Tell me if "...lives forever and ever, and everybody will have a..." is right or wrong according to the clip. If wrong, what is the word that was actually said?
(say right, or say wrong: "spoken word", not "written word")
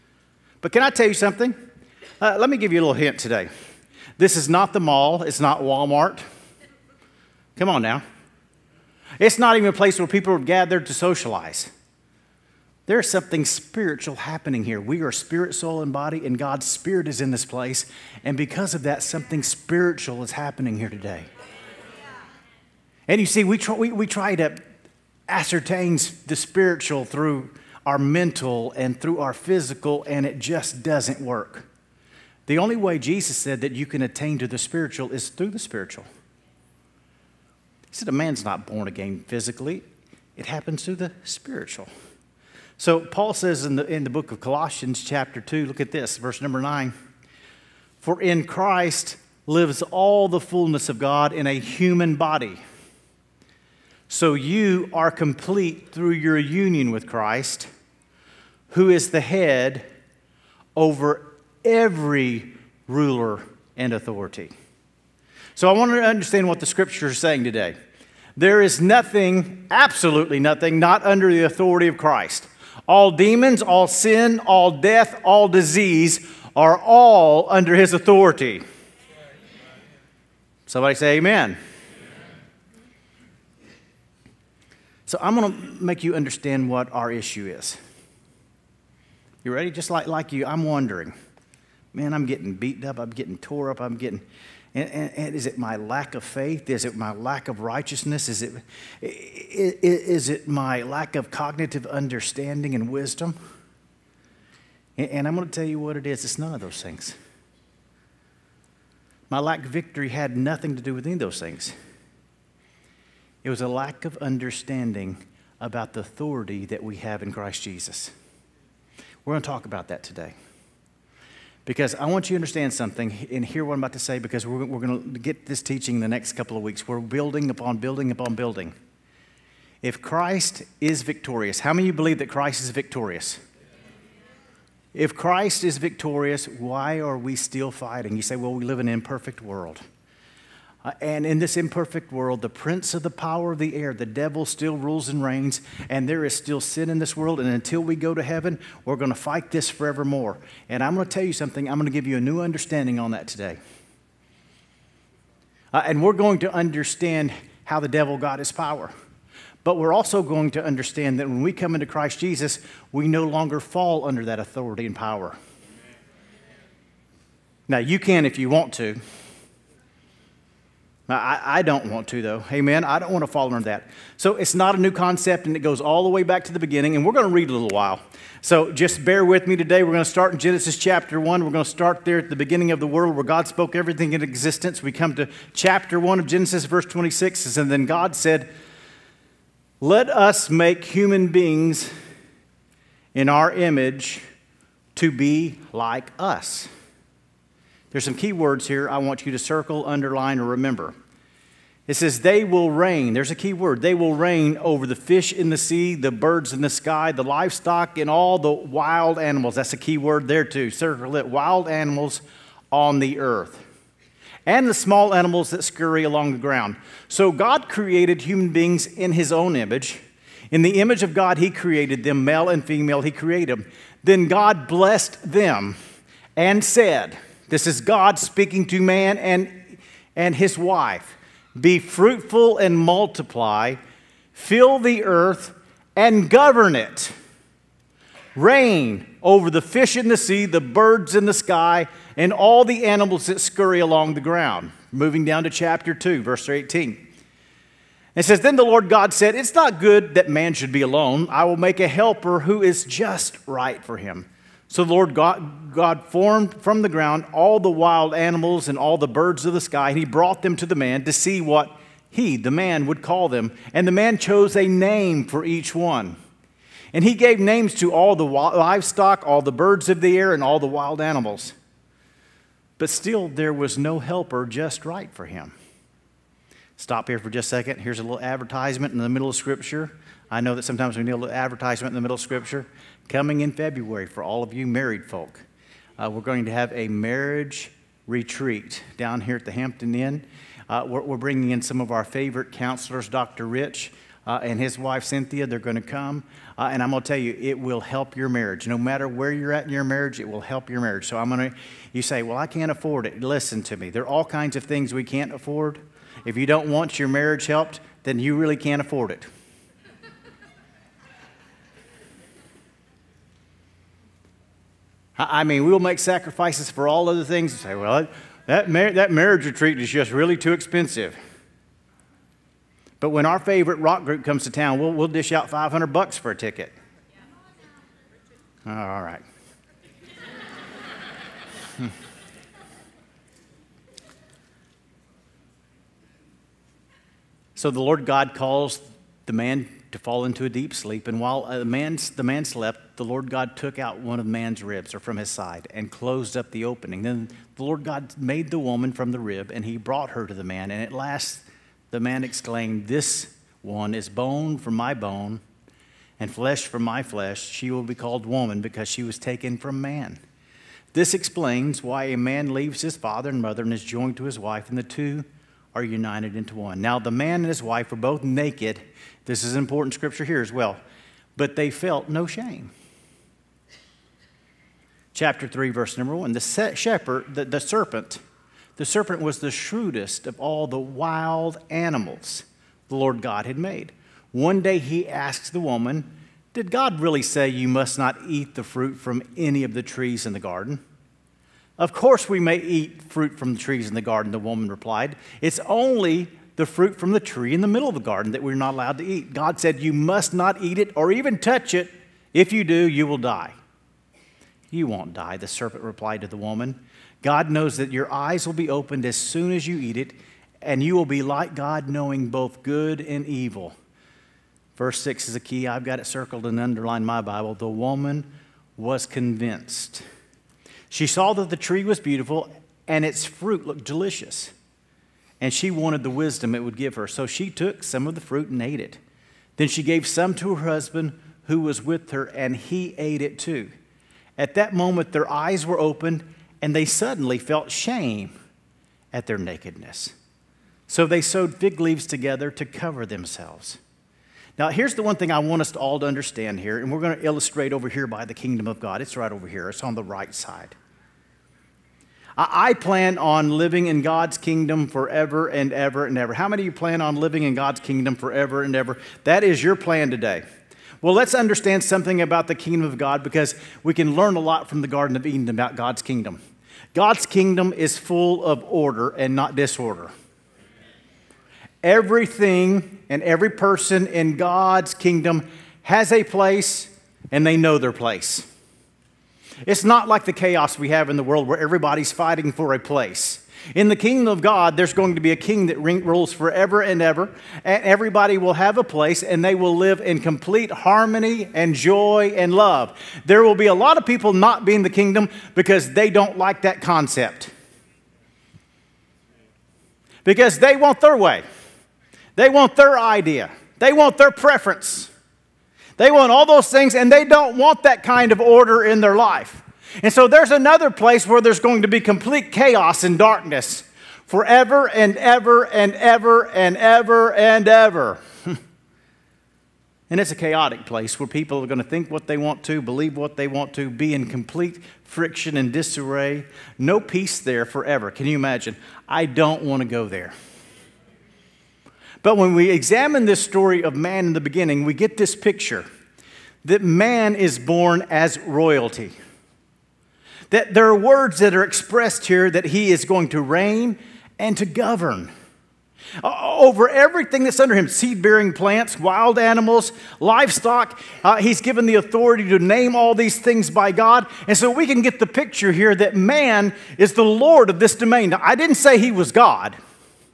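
wrong: "rules", not "lives".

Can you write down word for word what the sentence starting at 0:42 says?
So Paul says in the, in the book of Colossians, chapter 2, look at this, verse number 9.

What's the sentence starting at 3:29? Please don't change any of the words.
That's a key word there too.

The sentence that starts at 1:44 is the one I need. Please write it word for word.
And, and I'm going to tell you what it is it's none of those things.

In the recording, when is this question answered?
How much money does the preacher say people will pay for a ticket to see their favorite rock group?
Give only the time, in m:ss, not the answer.
5:25.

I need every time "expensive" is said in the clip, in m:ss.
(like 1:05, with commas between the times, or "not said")
5:20.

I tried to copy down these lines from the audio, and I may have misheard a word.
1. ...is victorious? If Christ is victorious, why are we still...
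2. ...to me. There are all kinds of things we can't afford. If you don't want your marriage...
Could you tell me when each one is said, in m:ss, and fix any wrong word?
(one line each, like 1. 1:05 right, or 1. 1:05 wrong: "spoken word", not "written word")
1. 2:12 right
2. 5:03 right.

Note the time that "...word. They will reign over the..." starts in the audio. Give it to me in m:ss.
3:23.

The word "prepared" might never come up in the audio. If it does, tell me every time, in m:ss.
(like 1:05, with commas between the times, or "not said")
not said.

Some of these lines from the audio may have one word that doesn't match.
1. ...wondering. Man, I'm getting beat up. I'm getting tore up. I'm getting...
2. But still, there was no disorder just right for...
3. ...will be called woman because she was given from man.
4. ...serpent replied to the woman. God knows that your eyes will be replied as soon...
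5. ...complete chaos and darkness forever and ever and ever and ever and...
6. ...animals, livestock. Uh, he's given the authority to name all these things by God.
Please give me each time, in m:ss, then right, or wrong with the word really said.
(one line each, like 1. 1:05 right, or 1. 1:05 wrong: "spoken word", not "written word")
1. 1:30 right
2. 4:32 wrong: "helper", not "disorder"
3. 5:57 wrong: "taken", not "given"
4. 6:45 wrong: "opened", not "replied"
5. 8:32 right
6. 9:09 right.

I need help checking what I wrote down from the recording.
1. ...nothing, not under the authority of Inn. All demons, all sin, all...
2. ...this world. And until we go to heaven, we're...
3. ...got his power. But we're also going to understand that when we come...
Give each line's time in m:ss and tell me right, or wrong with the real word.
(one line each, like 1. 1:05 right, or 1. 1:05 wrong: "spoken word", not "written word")
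1. 1:10 wrong: "Christ", not "Inn"
2. 2:26 right
3. 2:38 right.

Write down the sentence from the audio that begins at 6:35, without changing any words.
It's only the fruit from the tree in the middle of the garden that we're not allowed to eat.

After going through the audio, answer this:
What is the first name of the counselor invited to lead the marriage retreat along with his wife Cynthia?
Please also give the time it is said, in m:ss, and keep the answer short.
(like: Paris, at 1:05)
Rich, at 4:53.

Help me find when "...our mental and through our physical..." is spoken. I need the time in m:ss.
0:27.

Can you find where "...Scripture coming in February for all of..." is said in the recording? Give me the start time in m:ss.
4:42.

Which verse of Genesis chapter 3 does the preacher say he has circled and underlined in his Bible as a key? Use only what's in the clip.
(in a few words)
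6.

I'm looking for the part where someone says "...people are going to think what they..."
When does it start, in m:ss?
8:41.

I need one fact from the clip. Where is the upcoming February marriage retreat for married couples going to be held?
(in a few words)
Hampton Inn.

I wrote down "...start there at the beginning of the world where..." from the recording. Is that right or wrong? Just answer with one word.
right.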